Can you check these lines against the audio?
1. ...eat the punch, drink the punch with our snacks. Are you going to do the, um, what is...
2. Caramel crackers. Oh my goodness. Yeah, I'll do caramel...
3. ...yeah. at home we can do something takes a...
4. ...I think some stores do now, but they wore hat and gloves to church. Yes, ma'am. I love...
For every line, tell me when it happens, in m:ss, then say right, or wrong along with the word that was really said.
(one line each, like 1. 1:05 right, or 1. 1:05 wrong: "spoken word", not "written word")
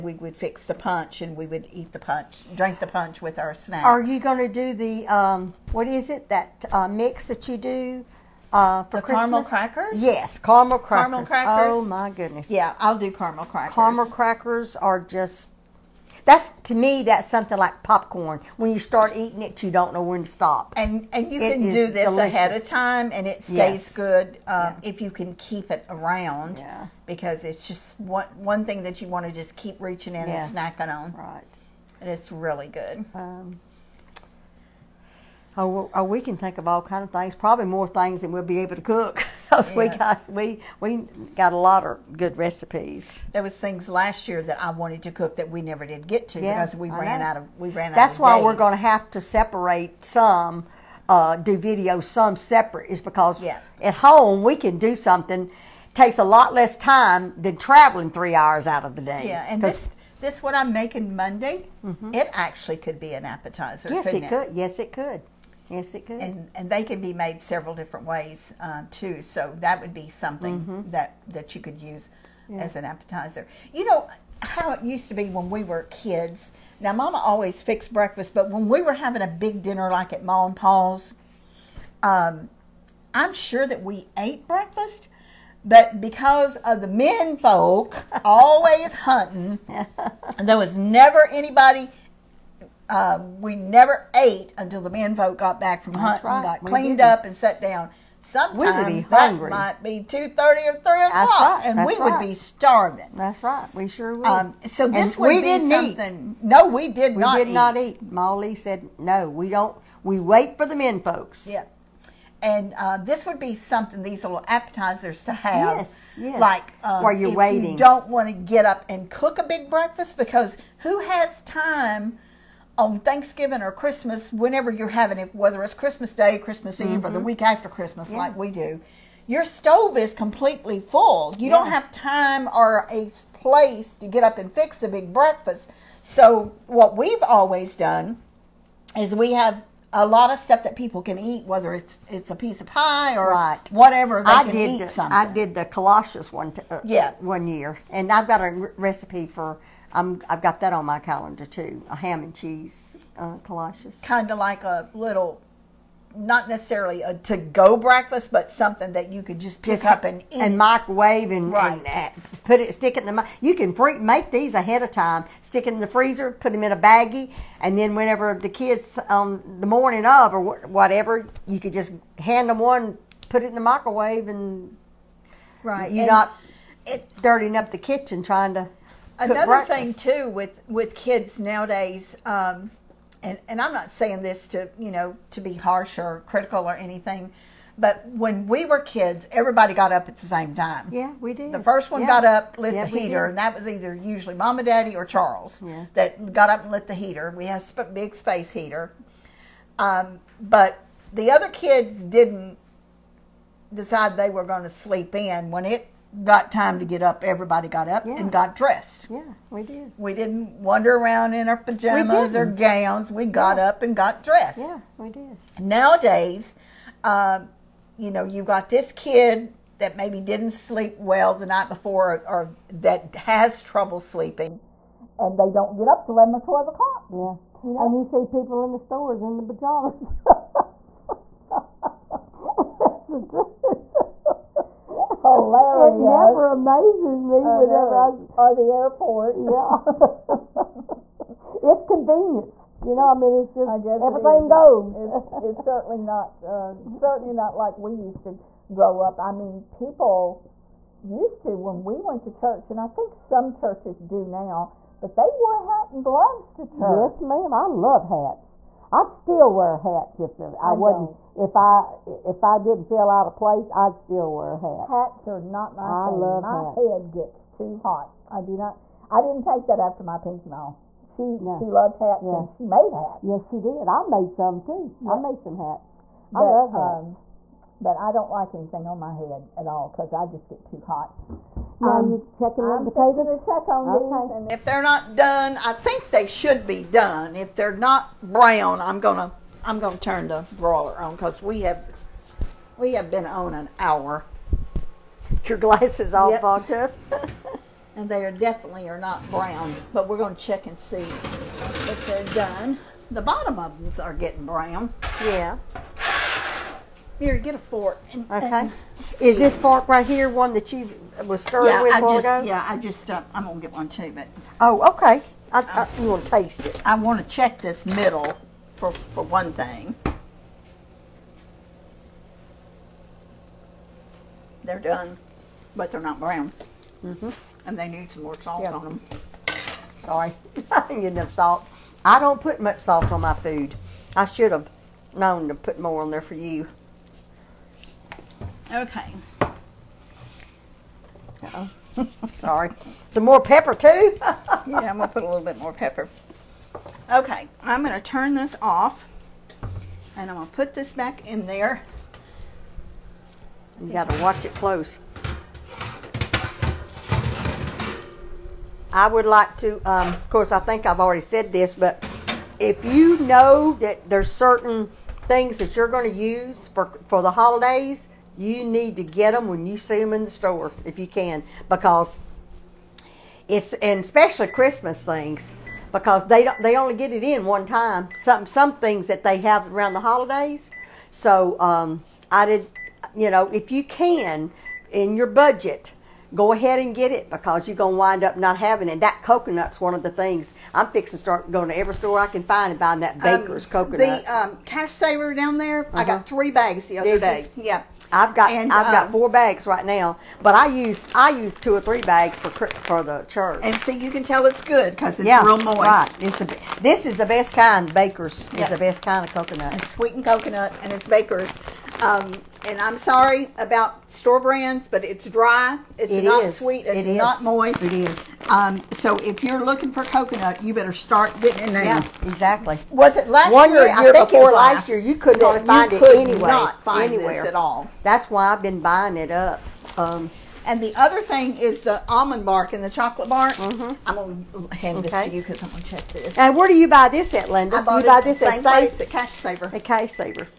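1. 0:01 right
2. 0:11 right
3. 0:53 right
4. 4:12 wrong: "churches", not "stores".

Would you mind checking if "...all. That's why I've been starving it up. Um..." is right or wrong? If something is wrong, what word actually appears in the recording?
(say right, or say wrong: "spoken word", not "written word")
wrong: "buying", not "starving".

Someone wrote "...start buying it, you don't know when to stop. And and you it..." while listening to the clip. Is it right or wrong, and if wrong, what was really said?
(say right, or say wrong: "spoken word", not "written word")
wrong: "eating", not "buying".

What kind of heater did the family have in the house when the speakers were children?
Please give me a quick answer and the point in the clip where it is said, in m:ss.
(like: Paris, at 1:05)
A big space heater, at 3:17.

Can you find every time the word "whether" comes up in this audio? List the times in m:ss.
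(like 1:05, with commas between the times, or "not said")
2:05, 2:21.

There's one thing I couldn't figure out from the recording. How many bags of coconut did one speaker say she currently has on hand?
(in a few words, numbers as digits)
4.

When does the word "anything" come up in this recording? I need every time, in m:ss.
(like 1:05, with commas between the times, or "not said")
3:06, 4:38.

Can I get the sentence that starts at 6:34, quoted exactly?
The um, cash saver down there, uh -huh.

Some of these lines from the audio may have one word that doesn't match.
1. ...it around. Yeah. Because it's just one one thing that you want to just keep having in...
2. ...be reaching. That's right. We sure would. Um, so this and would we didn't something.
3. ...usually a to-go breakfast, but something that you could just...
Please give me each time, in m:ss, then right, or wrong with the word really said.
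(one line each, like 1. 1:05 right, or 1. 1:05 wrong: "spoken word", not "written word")
1. 0:25 wrong: "reaching", not "having"
2. 1:42 wrong: "starving", not "reaching"
3. 2:36 wrong: "necessarily", not "usually".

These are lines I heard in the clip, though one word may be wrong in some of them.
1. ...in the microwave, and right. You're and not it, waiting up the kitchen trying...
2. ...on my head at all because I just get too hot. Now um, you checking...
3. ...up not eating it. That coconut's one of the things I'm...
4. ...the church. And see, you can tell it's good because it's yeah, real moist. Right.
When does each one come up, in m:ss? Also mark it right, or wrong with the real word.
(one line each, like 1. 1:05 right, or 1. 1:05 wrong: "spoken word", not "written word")
1. 2:53 wrong: "dirtying", not "waiting"
2. 4:38 right
3. 6:28 wrong: "having", not "eating"
4. 6:43 right.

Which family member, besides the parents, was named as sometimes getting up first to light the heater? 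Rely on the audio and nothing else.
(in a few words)
Charles.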